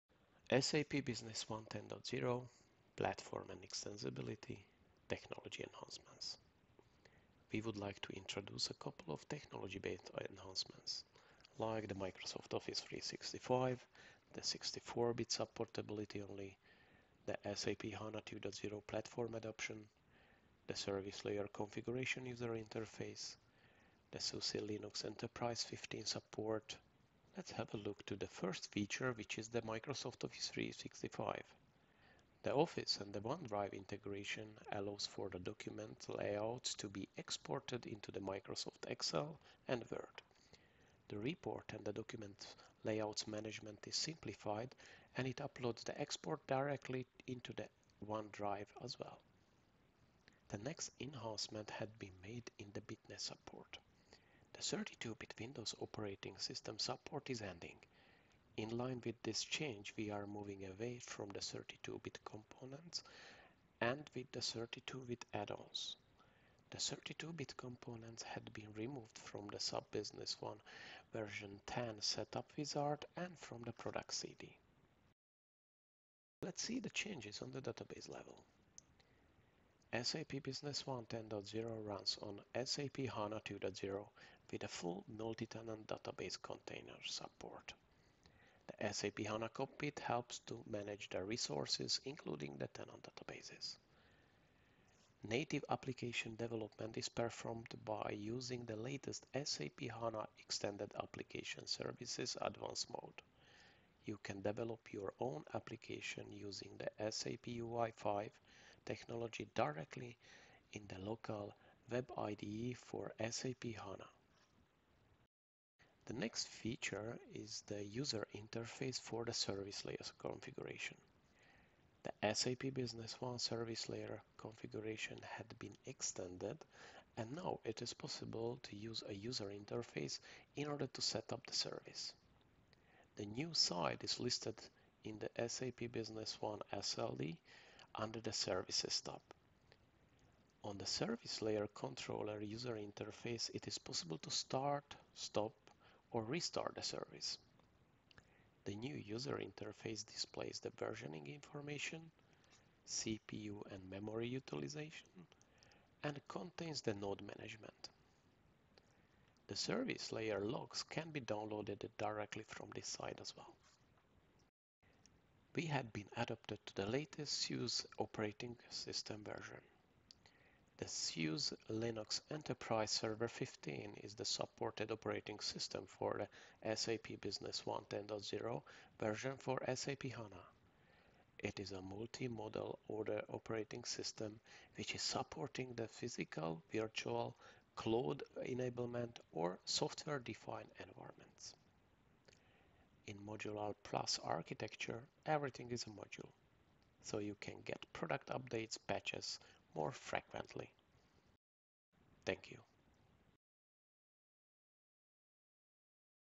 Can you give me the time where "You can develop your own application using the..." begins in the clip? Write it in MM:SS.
01:44.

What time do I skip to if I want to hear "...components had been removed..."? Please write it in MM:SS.
01:07.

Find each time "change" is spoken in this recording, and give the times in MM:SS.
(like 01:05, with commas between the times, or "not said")
00:59, 01:16.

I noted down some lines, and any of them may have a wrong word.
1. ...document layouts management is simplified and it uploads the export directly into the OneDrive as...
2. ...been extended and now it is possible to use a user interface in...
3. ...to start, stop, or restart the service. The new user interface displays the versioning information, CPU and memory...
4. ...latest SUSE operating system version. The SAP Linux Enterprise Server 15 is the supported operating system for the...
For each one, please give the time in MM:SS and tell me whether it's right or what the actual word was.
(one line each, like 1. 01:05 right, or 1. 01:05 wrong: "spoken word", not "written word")
1. 00:41 right
2. 02:05 right
3. 02:24 right
4. 02:46 wrong: "SUSE", not "SAP".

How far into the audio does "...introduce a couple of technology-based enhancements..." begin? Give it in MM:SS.
00:08.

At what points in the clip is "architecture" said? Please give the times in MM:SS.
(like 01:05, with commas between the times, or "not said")
03:14.